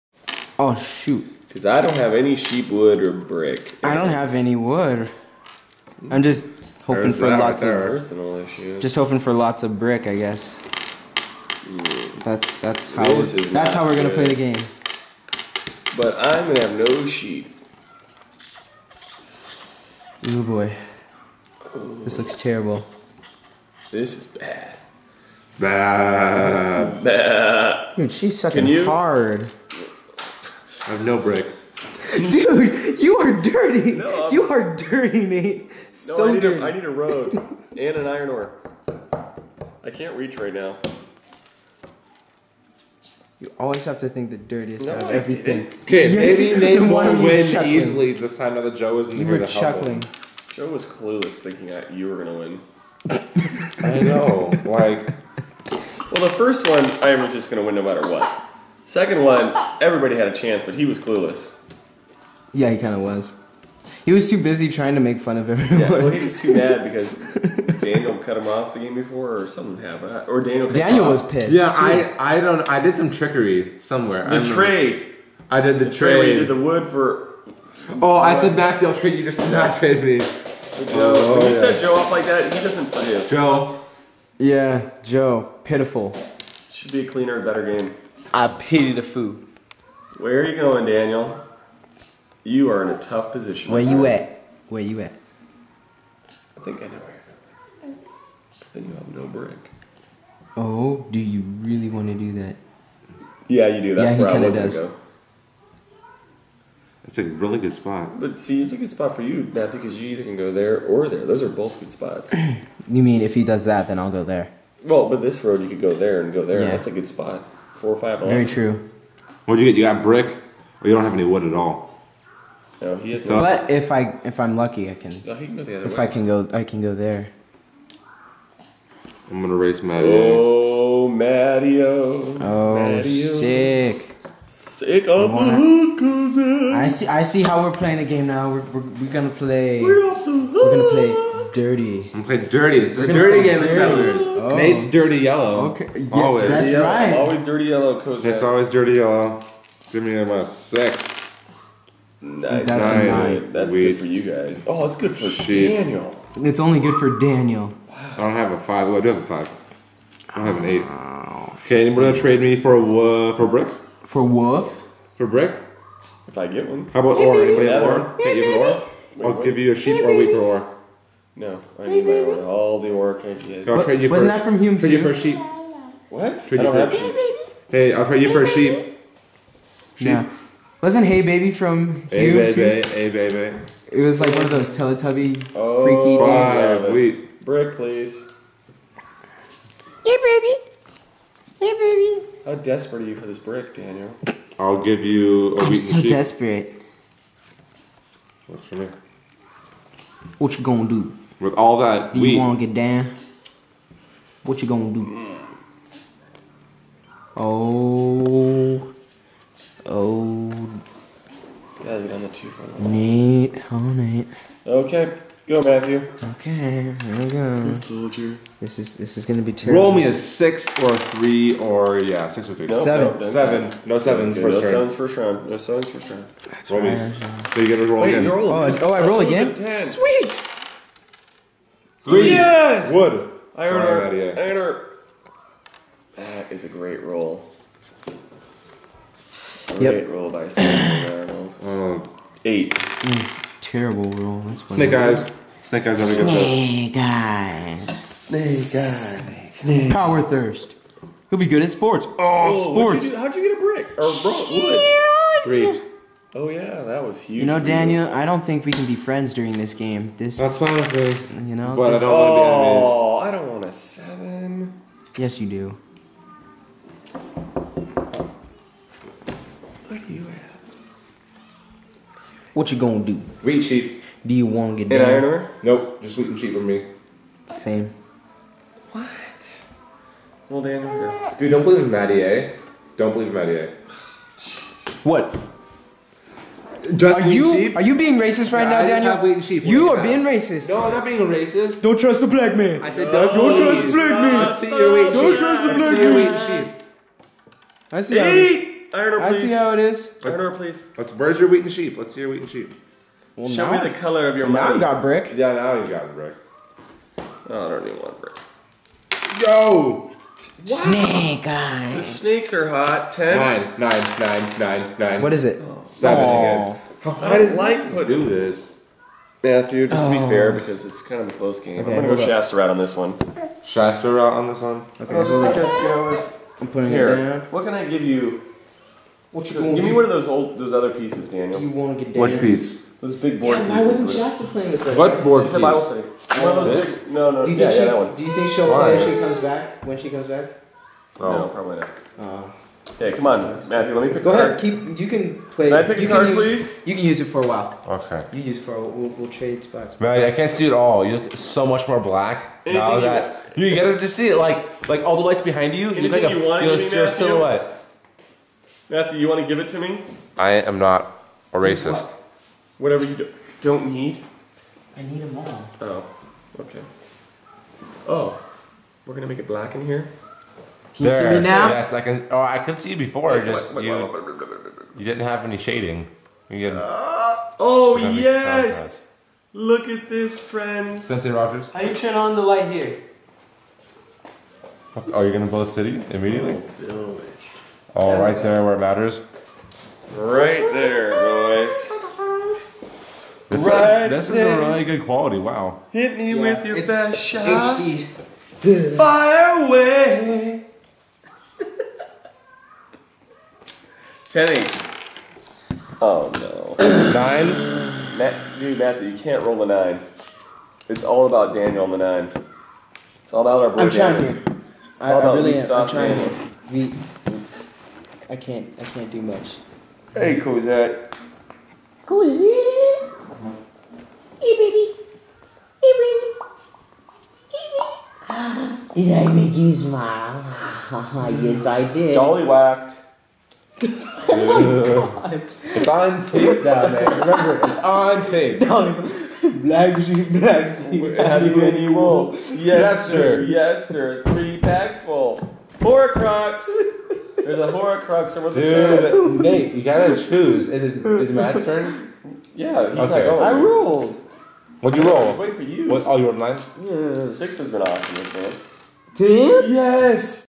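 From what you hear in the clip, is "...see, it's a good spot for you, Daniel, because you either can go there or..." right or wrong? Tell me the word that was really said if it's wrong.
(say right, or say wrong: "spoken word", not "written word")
wrong: "Matthew", not "Daniel".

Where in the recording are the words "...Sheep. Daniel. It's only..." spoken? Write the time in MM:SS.
02:35.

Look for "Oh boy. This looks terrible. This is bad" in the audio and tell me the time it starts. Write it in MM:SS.
00:20.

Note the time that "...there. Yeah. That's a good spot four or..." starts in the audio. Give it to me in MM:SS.
01:56.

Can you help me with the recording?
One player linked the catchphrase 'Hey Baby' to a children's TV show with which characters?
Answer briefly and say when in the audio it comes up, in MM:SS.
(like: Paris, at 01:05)
Teletubby, at 03:03.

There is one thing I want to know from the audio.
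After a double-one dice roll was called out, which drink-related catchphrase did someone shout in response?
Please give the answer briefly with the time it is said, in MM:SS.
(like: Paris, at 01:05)
Power thirst, at 04:09.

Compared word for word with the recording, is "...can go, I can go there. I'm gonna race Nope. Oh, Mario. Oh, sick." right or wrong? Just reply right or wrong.
wrong.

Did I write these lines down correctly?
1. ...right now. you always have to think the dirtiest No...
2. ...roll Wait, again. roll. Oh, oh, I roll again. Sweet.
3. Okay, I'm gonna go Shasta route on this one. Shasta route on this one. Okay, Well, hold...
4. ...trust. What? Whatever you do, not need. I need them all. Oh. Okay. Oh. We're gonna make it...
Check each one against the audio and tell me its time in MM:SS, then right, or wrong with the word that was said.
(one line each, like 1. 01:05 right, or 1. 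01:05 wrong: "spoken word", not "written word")
1. 00:40 right
2. 03:47 right
3. 05:21 right
4. 06:01 wrong: "racist", not "trust".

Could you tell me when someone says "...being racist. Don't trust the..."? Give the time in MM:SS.
04:51.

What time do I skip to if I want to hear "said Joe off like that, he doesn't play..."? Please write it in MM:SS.
01:21.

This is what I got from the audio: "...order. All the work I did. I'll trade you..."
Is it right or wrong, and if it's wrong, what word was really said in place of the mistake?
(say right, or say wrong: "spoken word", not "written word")
right.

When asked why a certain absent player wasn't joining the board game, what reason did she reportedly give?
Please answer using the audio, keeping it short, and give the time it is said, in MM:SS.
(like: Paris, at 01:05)
Bible study, at 05:35.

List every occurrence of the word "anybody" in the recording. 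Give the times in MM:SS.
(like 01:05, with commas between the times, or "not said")
02:41, 02:47.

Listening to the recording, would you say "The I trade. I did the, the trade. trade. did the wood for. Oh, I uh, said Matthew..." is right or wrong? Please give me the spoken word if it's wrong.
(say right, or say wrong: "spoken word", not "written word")
right.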